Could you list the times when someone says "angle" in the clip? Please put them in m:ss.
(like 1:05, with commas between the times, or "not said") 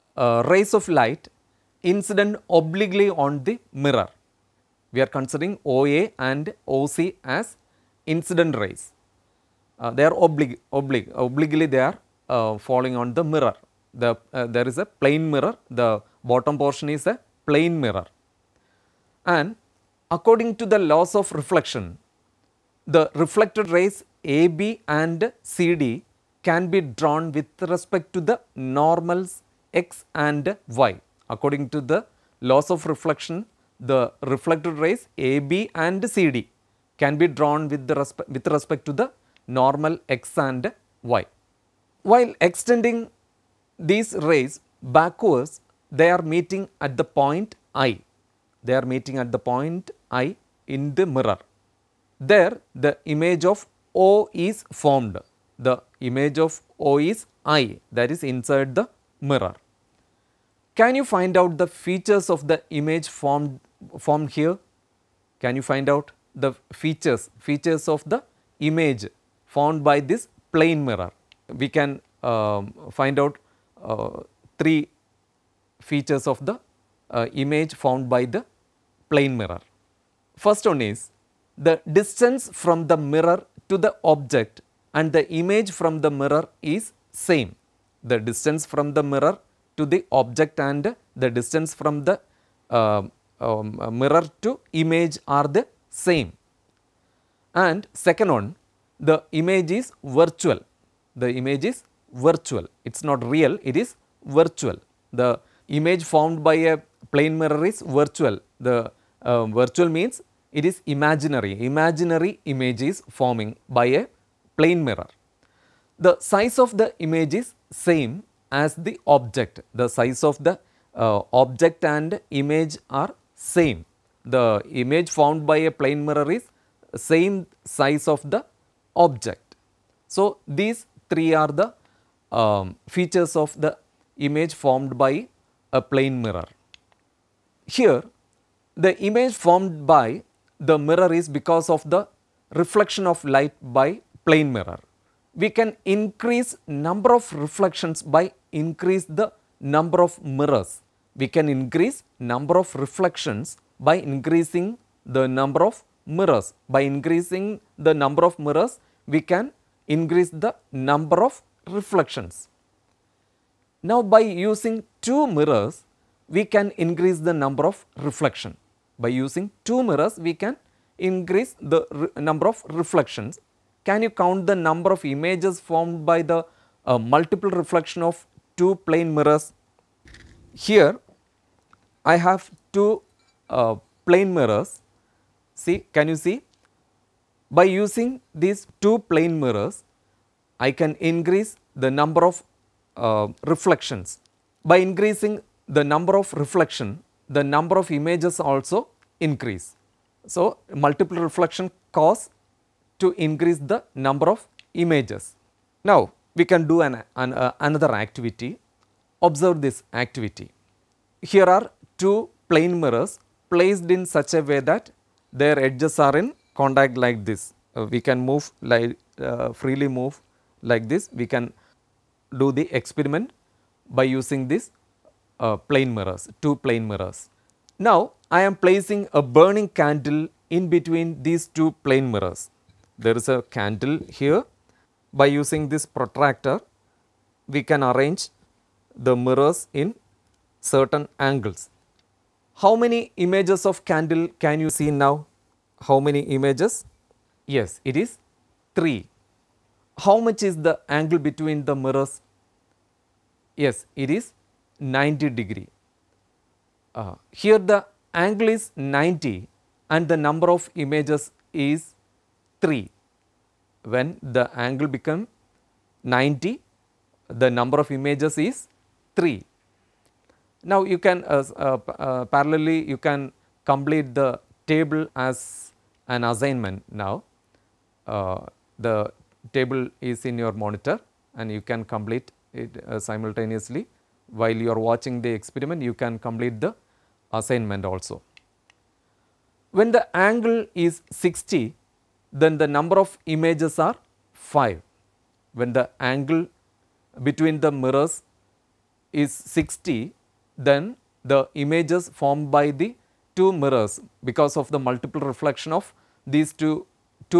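4:01, 4:10, 4:18, 4:24, 4:50, 4:56.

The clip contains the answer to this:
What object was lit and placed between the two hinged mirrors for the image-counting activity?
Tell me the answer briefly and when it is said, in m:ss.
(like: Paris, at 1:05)
Burning candle, at 3:49.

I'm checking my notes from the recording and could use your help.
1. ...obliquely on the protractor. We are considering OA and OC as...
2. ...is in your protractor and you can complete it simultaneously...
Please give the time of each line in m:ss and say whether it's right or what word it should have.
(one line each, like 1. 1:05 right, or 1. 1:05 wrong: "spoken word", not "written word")
1. 0:02 wrong: "mirror", not "protractor"
2. 4:40 wrong: "monitor", not "protractor".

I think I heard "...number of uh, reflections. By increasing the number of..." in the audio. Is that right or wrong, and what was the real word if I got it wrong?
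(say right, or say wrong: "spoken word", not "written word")
right.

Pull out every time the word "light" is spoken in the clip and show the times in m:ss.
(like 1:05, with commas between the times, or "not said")
0:00, 2:23.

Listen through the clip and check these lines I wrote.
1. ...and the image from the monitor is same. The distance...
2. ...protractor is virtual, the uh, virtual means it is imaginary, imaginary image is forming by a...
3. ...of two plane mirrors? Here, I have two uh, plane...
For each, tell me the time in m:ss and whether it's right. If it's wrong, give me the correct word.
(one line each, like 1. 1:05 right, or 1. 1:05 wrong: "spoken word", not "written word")
1. 1:24 wrong: "mirror", not "monitor"
2. 1:47 wrong: "mirror", not "protractor"
3. 2:58 right.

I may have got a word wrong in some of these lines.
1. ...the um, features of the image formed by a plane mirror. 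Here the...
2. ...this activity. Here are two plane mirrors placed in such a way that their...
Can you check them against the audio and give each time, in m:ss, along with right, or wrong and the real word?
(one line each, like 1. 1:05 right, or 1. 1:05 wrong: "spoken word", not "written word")
1. 2:11 right
2. 3:29 right.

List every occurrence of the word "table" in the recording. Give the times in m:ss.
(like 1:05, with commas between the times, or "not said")
4:34, 4:39.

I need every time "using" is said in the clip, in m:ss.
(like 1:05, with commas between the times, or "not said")
2:44, 2:49, 3:07, 3:44, 3:55.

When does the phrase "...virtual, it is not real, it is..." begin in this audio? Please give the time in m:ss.
1:42.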